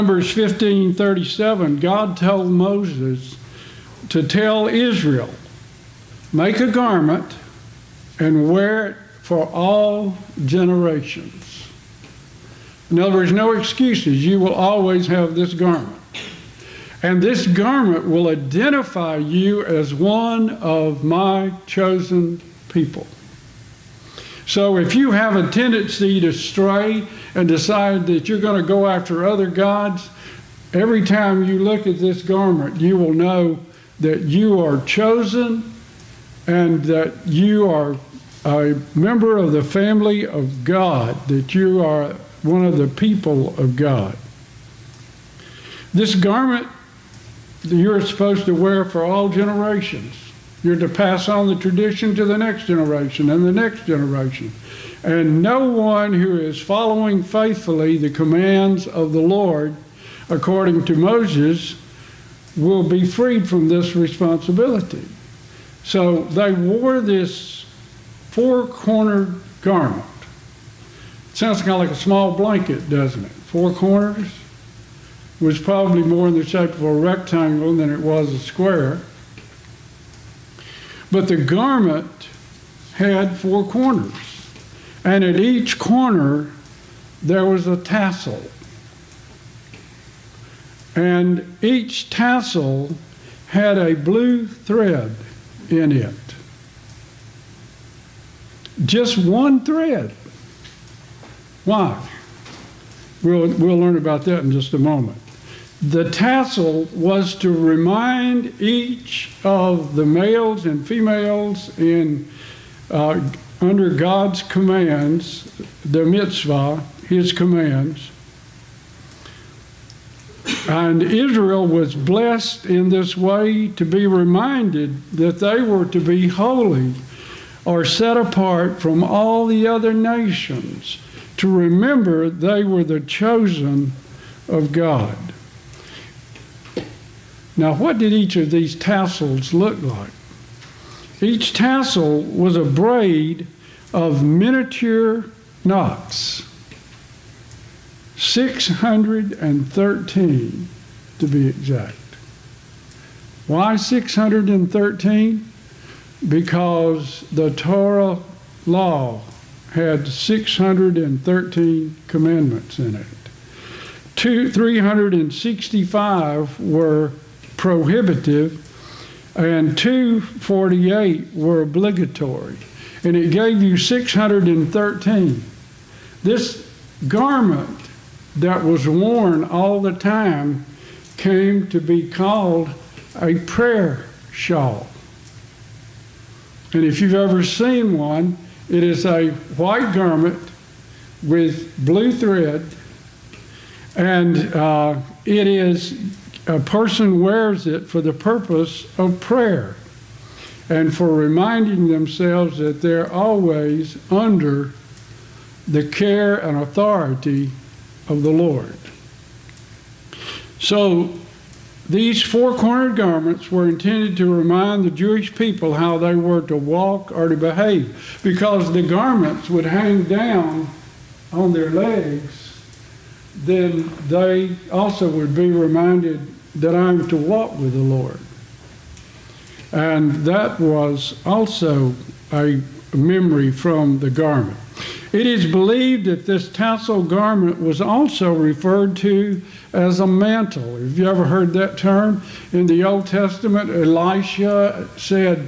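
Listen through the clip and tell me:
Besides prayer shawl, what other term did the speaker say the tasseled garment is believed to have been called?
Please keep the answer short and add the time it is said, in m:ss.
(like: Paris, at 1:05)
Mantle, at 4:00.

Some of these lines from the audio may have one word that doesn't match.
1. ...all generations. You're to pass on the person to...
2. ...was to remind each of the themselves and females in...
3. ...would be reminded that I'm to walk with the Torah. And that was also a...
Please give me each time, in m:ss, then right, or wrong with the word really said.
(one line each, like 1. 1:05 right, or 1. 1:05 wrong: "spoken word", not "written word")
1. 0:49 wrong: "tradition", not "person"
2. 1:46 wrong: "males", not "themselves"
3. 3:45 wrong: "Lord", not "Torah".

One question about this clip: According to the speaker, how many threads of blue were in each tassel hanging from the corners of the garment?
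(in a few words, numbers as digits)
1.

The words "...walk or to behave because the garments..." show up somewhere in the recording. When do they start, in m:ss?
3:36.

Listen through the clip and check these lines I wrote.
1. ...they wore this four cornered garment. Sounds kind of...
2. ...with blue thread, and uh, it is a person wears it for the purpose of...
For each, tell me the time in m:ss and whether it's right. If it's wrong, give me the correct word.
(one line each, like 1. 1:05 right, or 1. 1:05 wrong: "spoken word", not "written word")
1. 1:06 right
2. 3:11 right.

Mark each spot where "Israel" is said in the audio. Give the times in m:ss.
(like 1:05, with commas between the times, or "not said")
0:04, 2:01.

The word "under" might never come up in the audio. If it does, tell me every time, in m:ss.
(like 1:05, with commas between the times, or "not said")
1:53, 3:24.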